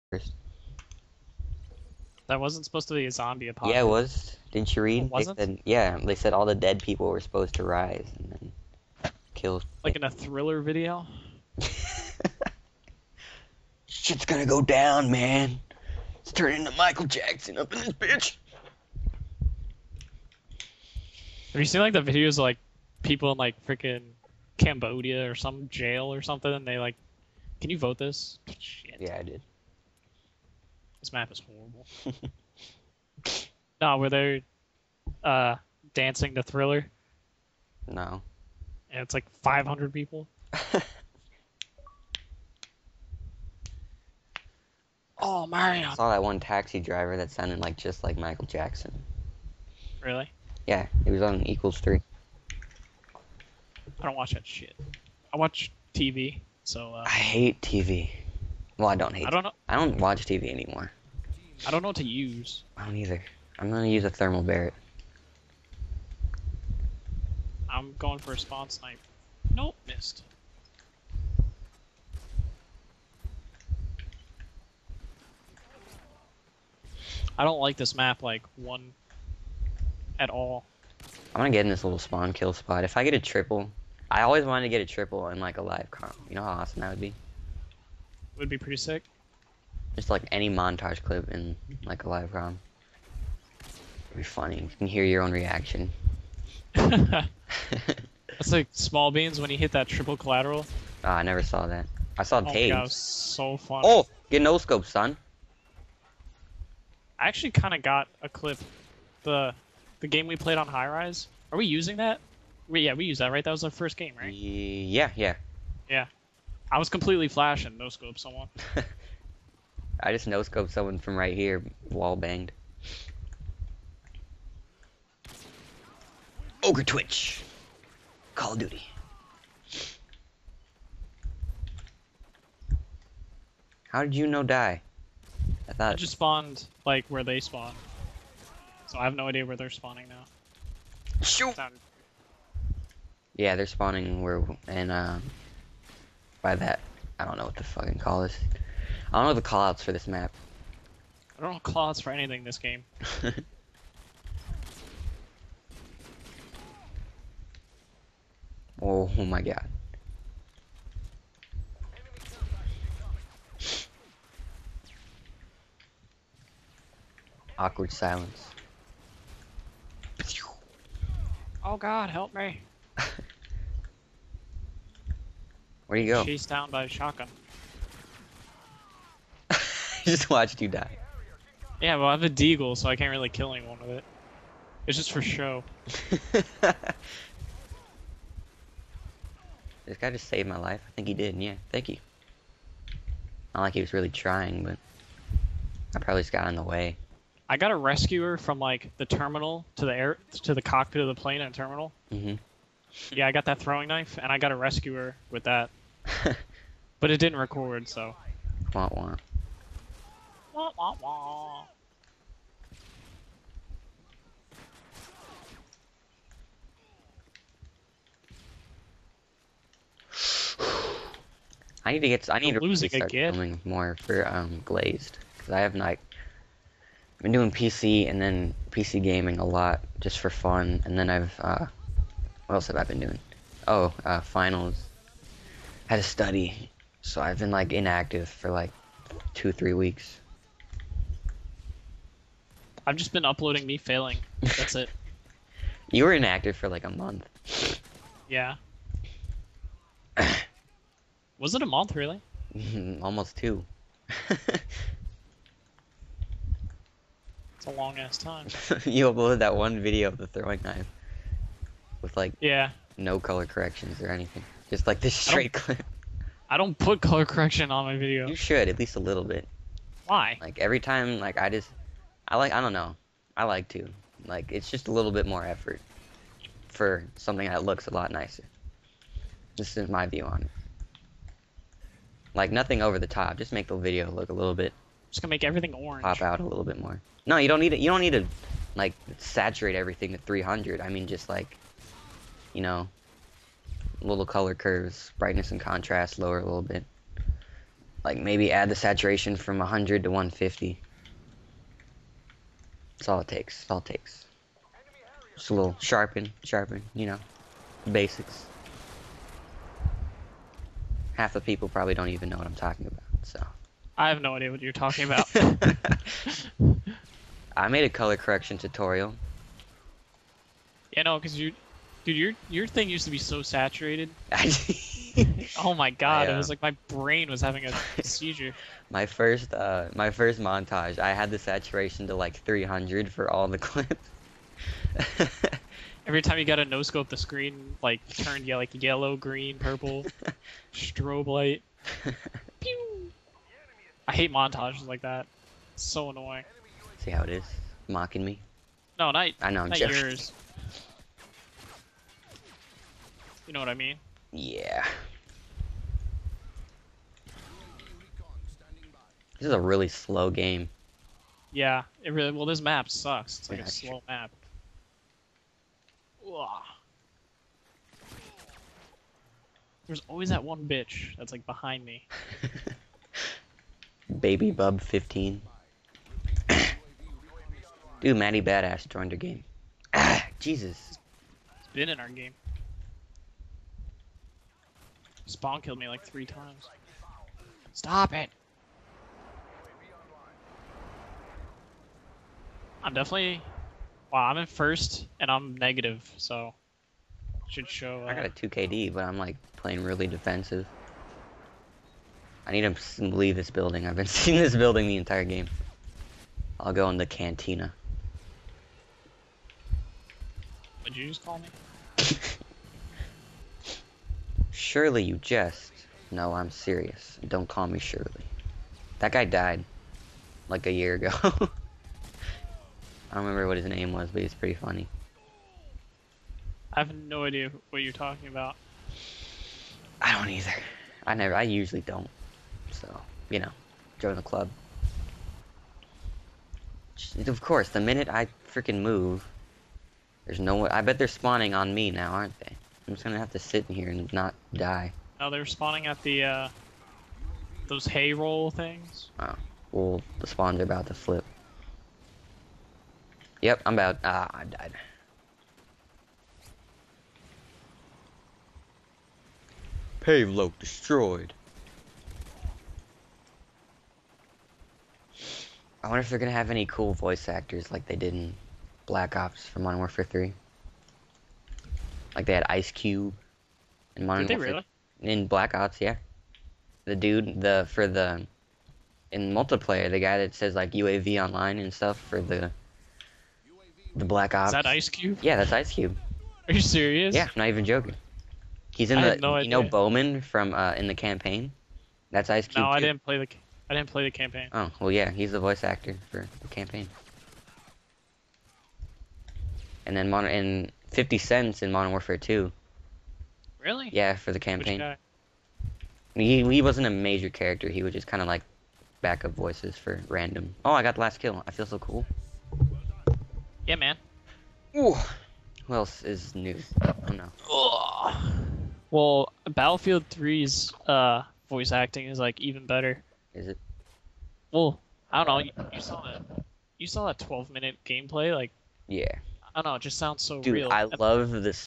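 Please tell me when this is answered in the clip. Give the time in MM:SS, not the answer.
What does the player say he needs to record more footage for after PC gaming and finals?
03:44.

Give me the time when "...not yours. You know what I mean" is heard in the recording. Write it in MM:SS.
05:49.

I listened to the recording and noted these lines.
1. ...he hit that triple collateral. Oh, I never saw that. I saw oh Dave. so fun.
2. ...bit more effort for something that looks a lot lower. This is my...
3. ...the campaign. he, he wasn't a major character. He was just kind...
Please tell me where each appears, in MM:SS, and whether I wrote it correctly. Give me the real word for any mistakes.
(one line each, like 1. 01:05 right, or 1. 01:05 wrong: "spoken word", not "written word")
1. 01:39 right
2. 04:35 wrong: "nicer", not "lower"
3. 08:24 right.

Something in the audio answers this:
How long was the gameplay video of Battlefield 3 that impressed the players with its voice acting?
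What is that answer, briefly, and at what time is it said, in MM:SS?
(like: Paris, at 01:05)
12 minutes, at 08:47.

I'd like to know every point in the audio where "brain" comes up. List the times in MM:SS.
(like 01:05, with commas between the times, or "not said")
05:26.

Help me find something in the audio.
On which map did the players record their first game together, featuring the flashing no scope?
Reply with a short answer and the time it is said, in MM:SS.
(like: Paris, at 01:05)
High Rise, at 01:50.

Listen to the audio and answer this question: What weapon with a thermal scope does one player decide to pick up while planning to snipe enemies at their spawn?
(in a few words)
Barrett.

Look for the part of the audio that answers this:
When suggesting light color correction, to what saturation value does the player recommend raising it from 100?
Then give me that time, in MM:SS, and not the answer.
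05:00.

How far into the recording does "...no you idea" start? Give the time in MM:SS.
08:09.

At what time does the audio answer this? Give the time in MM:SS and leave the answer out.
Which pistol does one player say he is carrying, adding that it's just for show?
03:02.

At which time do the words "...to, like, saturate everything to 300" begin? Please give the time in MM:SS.
04:48.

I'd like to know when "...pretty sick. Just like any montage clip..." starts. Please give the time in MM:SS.
01:28.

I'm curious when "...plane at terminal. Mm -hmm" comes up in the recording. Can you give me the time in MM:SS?
03:21.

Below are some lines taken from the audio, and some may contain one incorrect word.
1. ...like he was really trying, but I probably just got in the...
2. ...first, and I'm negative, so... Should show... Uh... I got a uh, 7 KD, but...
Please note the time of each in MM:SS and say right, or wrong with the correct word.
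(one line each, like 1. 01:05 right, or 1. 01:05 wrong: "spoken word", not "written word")
1. 03:13 right
2. 06:34 wrong: "2", not "7".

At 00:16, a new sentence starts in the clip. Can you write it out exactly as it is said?
It's turning into Michael Jackson up in this bitch.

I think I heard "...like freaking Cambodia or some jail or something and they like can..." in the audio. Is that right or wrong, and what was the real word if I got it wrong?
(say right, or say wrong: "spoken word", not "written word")
right.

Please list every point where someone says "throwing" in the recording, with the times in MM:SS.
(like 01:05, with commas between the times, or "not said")
03:23, 04:20.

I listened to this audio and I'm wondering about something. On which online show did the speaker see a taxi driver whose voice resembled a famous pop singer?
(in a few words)
Equals 3.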